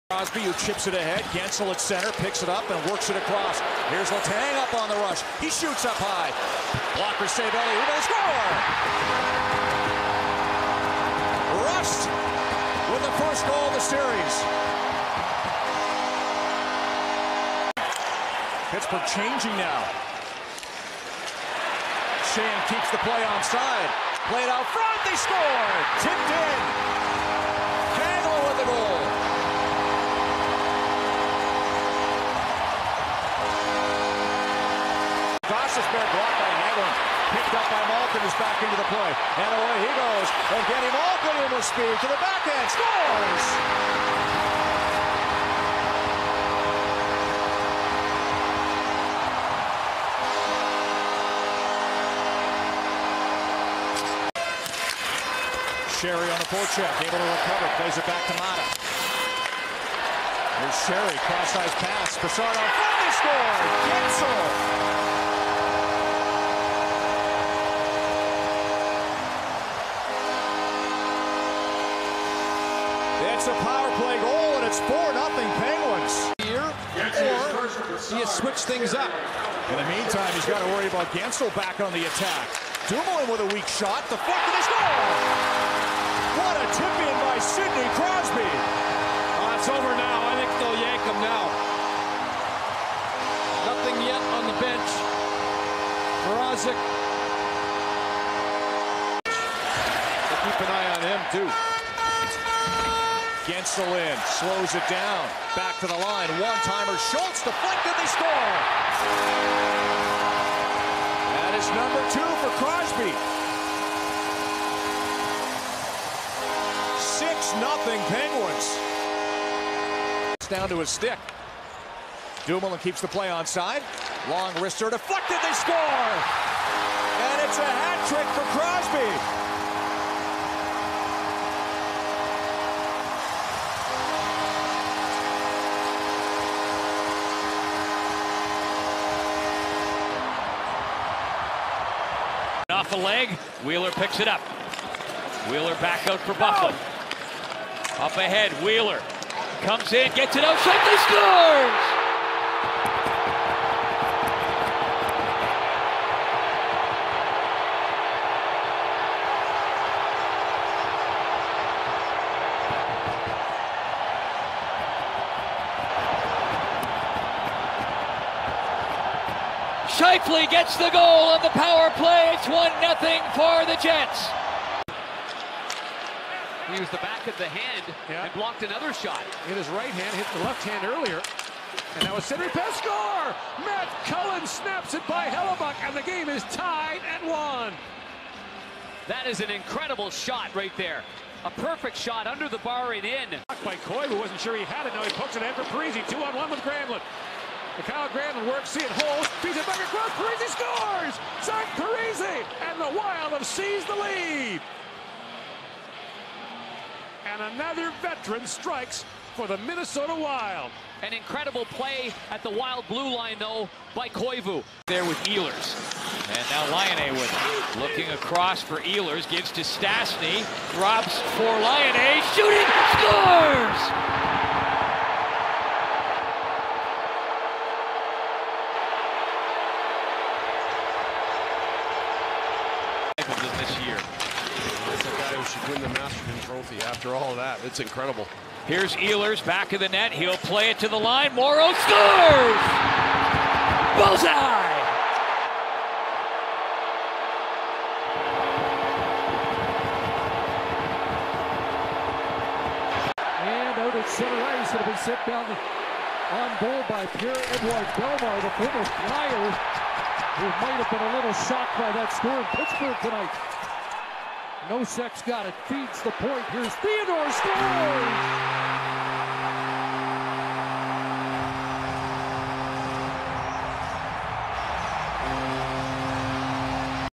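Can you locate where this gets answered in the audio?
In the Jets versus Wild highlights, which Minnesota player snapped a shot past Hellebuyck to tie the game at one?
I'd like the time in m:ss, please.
3:03.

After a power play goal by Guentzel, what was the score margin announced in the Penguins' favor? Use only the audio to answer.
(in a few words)
4-0.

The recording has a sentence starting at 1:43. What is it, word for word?
Against the line, slows it down.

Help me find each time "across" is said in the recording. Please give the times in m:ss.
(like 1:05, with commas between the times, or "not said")
0:03, 3:38.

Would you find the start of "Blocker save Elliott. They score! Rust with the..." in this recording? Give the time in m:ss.
0:06.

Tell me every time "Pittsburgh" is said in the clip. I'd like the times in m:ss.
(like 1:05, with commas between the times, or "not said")
0:18, 4:22.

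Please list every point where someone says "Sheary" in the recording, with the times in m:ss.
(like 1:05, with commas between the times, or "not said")
0:55, 1:00.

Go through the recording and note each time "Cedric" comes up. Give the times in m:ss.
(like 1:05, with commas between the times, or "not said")
3:02.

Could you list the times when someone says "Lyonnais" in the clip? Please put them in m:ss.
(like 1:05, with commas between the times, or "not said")
3:36, 3:41.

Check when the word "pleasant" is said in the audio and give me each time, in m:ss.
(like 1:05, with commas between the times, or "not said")
not said.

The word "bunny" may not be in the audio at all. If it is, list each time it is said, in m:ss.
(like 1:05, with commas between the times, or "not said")
not said.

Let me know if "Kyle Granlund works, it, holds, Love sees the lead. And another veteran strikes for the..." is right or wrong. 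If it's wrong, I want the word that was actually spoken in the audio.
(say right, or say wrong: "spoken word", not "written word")
right.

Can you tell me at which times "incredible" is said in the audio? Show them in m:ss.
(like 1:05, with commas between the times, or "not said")
3:09, 3:31, 3:57.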